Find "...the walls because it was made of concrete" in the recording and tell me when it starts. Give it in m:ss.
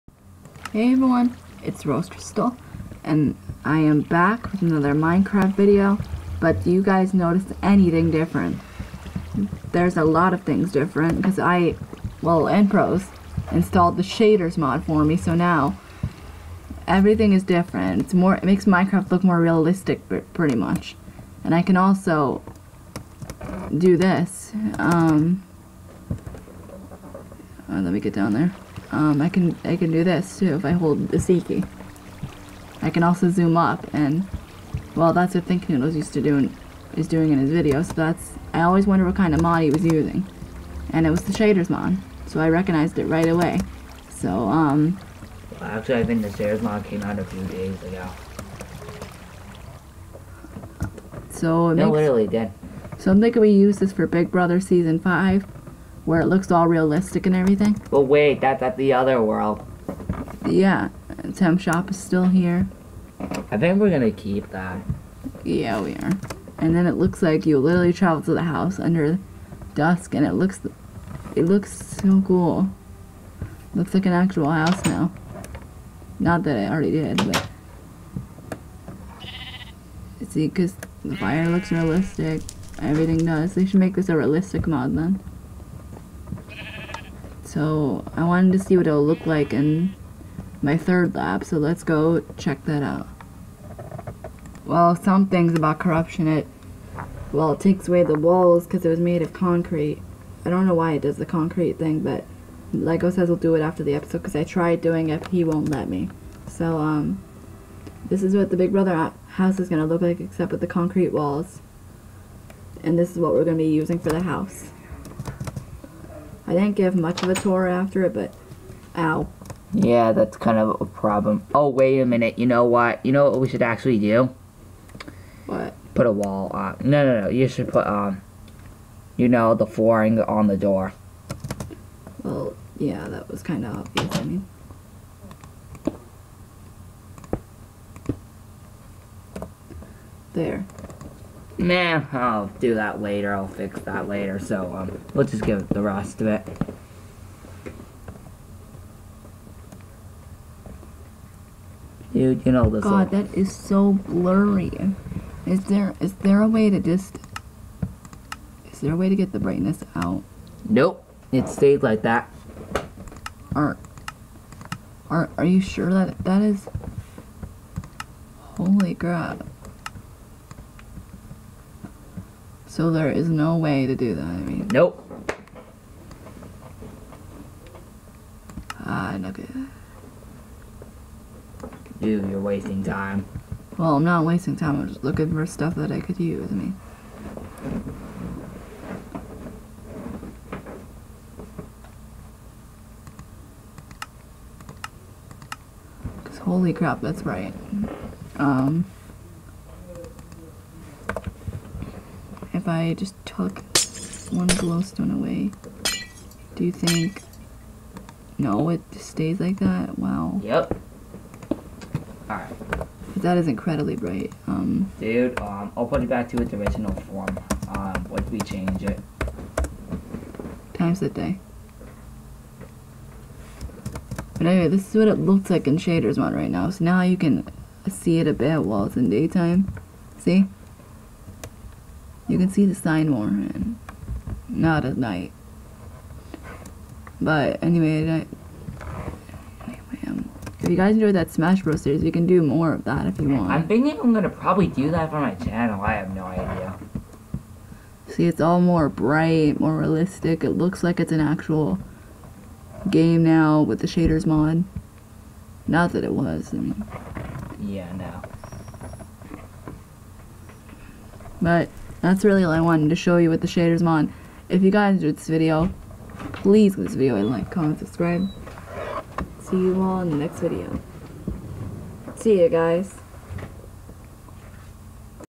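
1:38.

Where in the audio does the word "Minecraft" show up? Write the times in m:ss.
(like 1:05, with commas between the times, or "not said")
0:04, 0:18.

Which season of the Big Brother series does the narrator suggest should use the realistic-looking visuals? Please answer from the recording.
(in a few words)
Season 5.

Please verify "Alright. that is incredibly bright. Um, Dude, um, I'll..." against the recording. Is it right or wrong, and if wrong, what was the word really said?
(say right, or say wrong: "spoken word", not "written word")
right.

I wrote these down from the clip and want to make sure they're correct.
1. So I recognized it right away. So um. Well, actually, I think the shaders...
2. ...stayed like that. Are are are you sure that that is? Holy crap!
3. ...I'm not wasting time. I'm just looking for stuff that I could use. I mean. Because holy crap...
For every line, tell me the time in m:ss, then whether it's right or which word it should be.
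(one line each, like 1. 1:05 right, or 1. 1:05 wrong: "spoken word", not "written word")
1. 0:42 right
2. 2:41 right
3. 3:03 right.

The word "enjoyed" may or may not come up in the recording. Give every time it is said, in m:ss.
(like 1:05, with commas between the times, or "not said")
4:00, 4:24.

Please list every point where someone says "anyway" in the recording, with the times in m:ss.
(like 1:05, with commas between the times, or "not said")
3:44, 3:57.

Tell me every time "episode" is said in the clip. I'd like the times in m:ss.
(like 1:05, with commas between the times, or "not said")
1:43.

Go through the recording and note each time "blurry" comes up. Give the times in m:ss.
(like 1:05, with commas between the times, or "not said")
2:33.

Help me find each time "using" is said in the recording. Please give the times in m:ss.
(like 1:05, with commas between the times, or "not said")
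0:39, 1:53.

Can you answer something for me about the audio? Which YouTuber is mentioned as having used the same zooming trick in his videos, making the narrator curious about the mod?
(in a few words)
ThinkNoodles.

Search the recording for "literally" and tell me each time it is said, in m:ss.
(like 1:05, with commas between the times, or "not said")
0:51, 1:07.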